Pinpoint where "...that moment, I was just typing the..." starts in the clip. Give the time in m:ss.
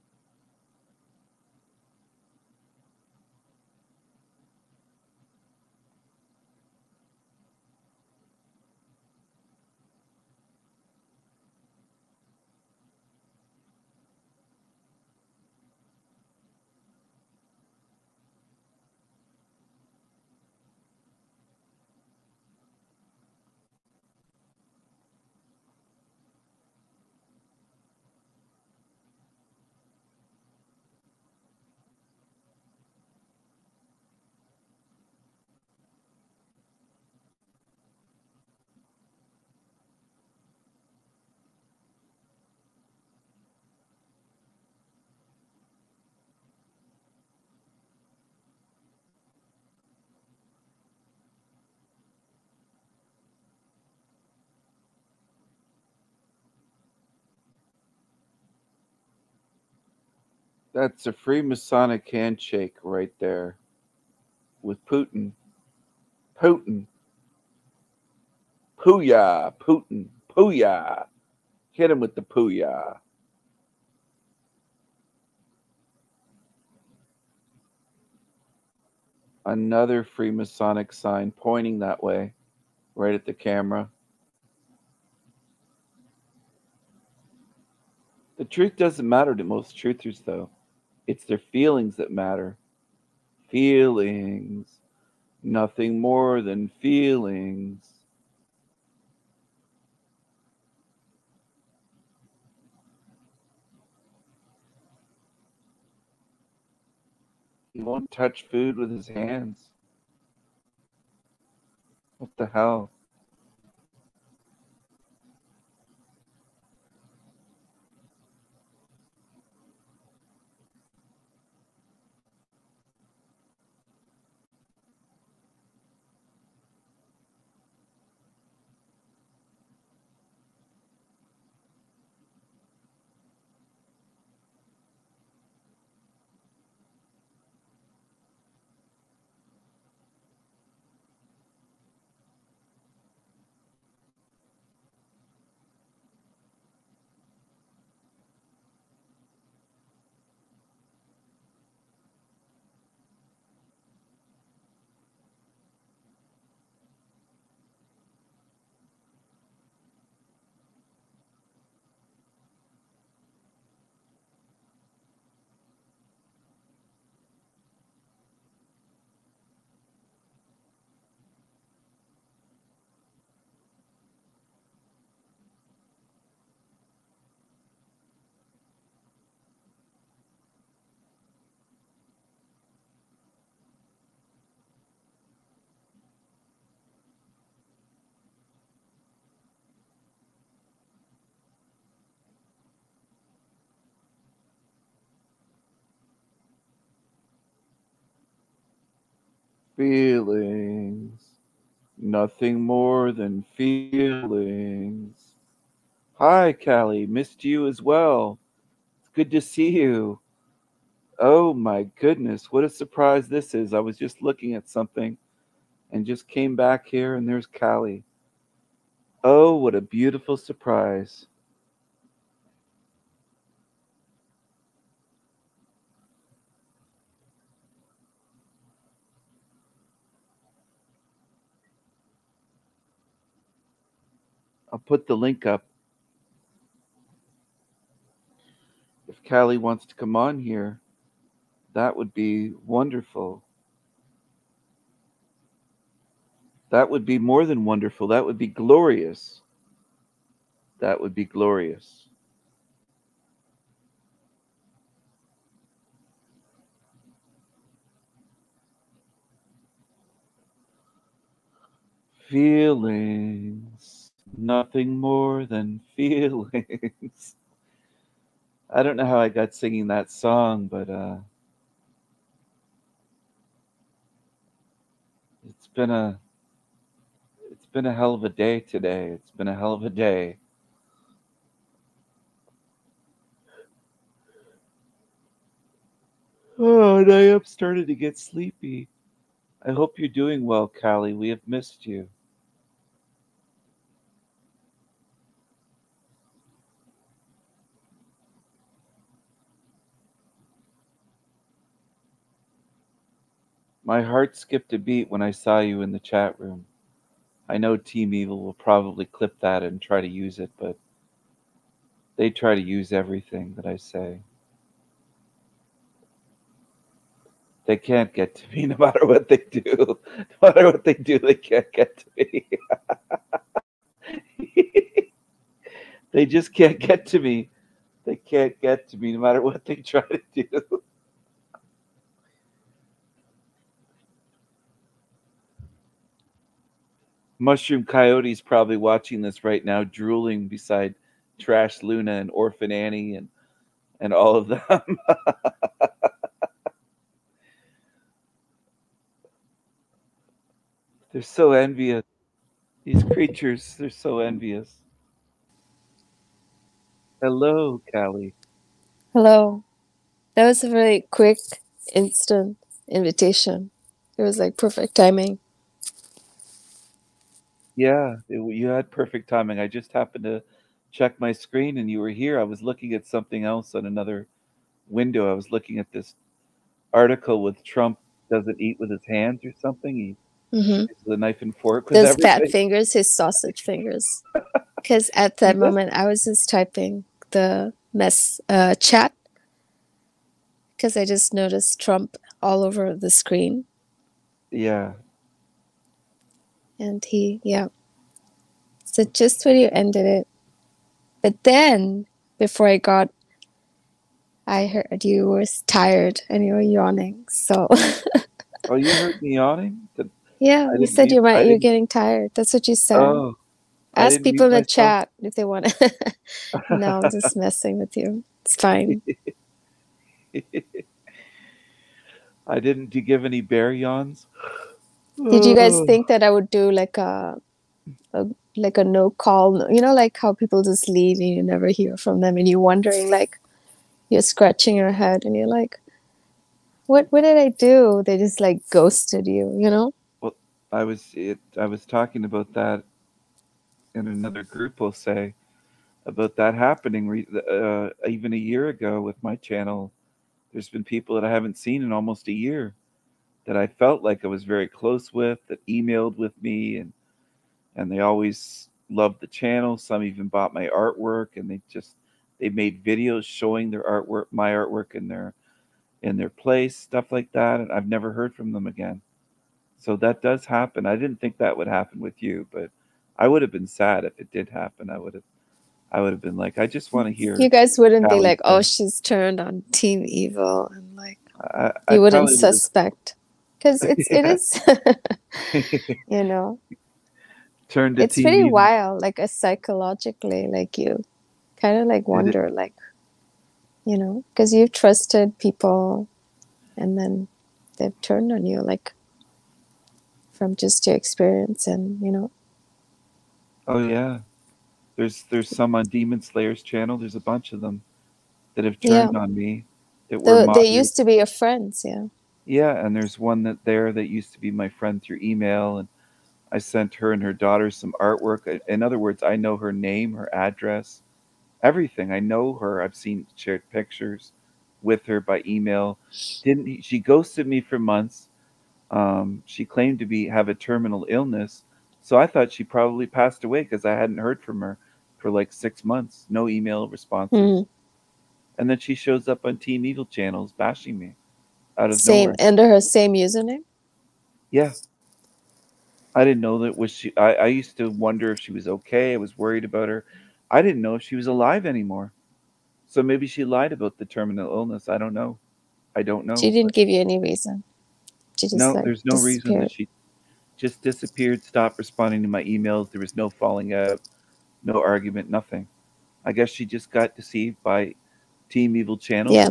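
6:25.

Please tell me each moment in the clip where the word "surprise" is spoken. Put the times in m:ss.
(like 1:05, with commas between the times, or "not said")
3:32, 3:40.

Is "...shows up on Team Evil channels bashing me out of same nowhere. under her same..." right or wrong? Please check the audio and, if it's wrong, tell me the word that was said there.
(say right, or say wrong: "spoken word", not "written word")
right.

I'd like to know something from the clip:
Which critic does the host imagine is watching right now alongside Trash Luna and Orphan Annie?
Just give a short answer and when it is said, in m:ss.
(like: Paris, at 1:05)
Mushroom Coyote, at 5:37.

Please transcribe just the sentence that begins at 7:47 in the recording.
And I've never heard from them again.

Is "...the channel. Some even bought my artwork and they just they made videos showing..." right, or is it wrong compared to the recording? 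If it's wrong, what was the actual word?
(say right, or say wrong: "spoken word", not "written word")
right.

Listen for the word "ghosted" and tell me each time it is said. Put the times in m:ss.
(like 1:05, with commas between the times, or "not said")
7:18, 8:46.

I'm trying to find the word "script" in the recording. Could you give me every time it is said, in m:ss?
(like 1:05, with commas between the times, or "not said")
not said.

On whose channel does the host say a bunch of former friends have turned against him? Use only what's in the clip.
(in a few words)
Demon Slayer's.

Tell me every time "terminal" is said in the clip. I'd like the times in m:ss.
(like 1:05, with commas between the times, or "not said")
8:50, 9:14.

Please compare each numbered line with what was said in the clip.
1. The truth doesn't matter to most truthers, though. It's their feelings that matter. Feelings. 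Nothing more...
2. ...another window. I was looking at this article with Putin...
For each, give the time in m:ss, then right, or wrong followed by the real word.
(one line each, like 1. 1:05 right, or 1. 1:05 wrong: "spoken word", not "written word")
1. 1:28 right
2. 6:13 wrong: "Trump", not "Putin".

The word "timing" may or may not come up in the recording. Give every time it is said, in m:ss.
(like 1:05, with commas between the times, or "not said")
6:04, 6:09.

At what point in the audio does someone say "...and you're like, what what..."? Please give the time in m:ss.
7:15.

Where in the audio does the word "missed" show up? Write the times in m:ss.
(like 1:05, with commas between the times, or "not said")
3:27, 4:51.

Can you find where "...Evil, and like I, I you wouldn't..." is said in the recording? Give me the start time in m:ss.
8:00.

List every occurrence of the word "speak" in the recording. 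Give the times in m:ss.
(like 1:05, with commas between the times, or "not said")
not said.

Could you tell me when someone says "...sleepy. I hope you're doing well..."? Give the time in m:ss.
4:48.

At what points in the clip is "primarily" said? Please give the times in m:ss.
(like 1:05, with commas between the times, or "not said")
not said.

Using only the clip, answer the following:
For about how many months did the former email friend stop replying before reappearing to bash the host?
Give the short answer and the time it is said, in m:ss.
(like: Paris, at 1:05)
6, at 8:55.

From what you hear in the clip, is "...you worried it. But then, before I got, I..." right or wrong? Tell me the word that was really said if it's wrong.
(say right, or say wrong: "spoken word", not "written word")
wrong: "ended", not "worried".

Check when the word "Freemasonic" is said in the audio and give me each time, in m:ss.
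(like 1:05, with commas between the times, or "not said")
1:01, 1:20.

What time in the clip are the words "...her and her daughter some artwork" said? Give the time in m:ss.
8:36.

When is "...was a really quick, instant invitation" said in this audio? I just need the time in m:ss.
6:00.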